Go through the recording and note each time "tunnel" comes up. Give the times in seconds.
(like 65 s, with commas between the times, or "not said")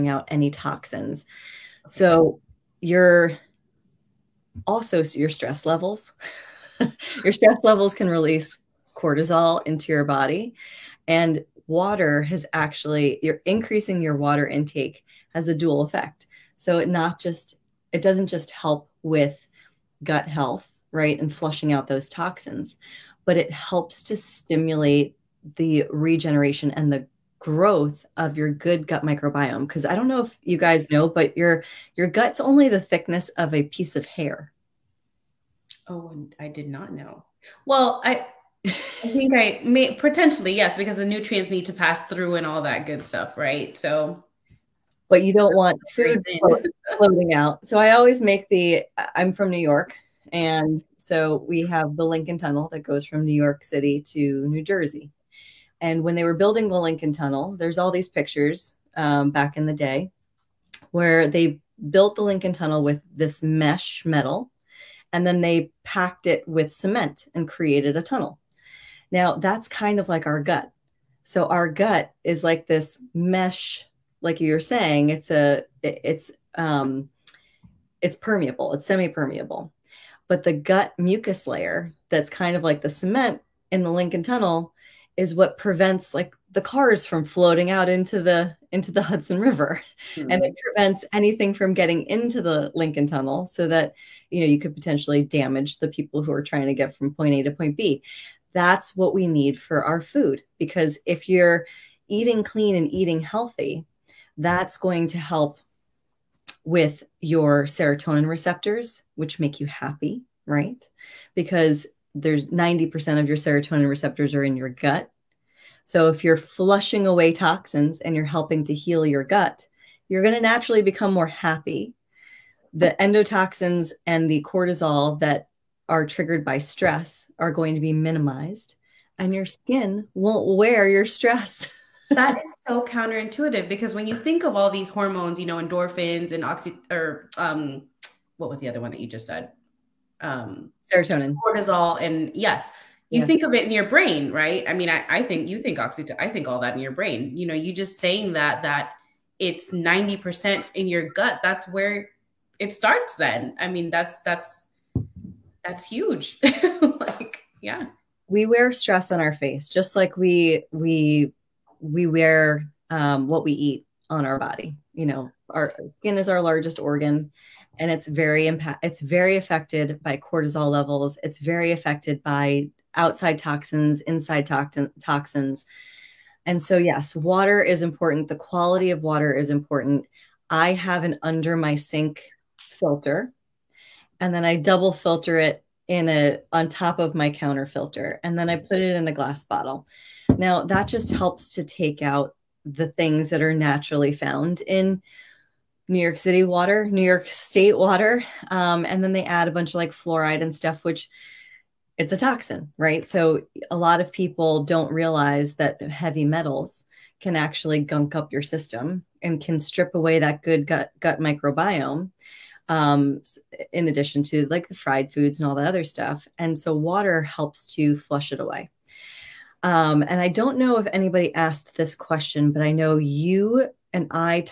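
52 s, 57 s, 62 s, 68 s, 84 s, 93 s.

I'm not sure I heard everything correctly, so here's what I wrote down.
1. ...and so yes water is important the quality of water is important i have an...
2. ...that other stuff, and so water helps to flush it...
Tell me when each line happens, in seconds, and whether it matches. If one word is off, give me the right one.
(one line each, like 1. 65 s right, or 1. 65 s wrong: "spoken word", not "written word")
1. 176 s right
2. 215 s right.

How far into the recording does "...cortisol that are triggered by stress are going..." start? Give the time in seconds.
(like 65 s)
124 s.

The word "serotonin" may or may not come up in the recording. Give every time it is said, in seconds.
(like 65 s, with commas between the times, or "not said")
107 s, 113 s, 140 s.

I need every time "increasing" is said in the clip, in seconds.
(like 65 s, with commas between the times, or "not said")
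13 s.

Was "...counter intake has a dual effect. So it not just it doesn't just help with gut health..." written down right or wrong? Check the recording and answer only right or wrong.
wrong.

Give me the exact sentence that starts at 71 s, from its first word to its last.
So our gut is like this mesh like you're saying it's a it's um it's permeable, it's semi-permeable.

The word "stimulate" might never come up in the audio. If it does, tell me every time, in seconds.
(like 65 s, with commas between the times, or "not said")
24 s.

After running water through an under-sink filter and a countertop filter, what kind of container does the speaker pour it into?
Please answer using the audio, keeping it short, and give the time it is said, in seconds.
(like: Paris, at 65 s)
glass bottle, at 189 s.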